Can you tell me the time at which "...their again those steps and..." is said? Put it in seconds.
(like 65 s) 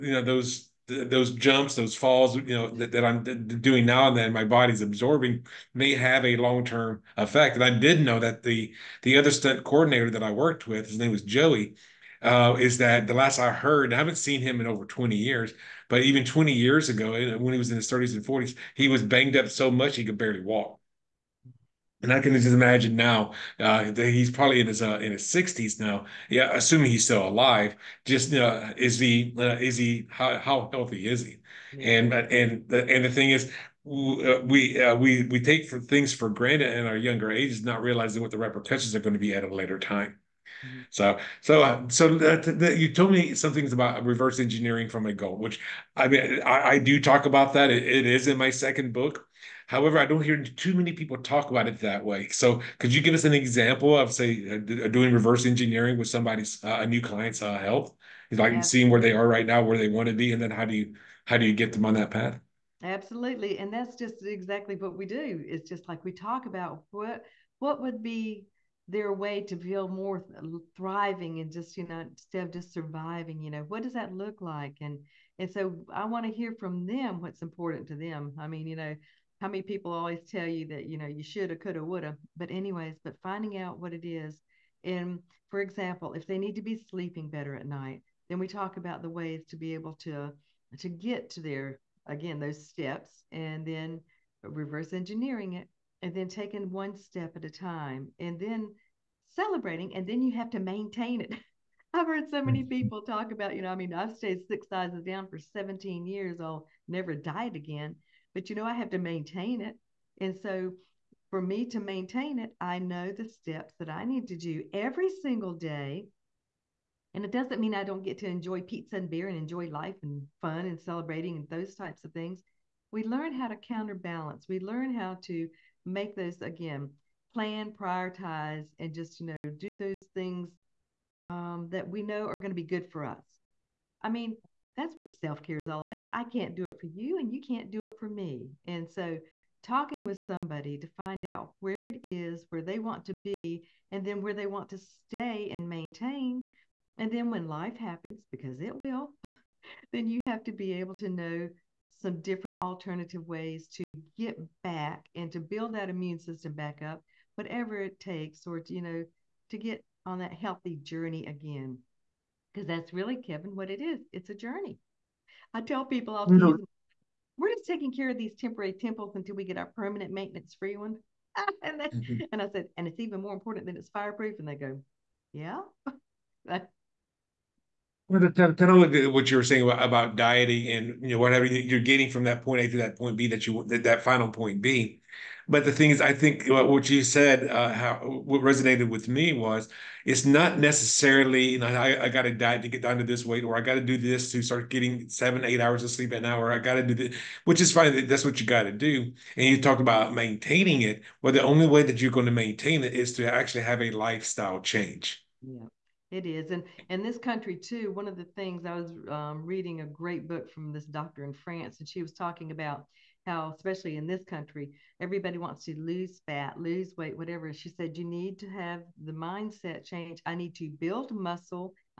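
91 s.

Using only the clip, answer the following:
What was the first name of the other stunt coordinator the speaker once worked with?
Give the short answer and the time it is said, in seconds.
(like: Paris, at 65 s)
Joey, at 11 s.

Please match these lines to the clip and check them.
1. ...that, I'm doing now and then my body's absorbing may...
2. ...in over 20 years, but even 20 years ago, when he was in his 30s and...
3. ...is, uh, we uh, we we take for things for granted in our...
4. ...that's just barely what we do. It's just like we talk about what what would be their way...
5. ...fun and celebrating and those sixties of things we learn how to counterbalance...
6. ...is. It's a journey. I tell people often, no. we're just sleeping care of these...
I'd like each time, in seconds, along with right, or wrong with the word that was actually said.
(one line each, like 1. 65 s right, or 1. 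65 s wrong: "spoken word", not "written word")
1. 2 s right
2. 14 s right
3. 33 s right
4. 63 s wrong: "exactly", not "barely"
5. 120 s wrong: "types", not "sixties"
6. 163 s wrong: "taking", not "sleeping".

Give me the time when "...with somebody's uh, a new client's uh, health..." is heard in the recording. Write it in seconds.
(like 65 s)
55 s.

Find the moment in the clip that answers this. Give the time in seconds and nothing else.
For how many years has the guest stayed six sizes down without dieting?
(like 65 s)
105 s.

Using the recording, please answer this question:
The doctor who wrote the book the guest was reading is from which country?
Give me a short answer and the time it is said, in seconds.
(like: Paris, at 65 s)
France, at 211 s.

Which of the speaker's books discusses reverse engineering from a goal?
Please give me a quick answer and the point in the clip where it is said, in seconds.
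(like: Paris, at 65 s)
Second book, at 48 s.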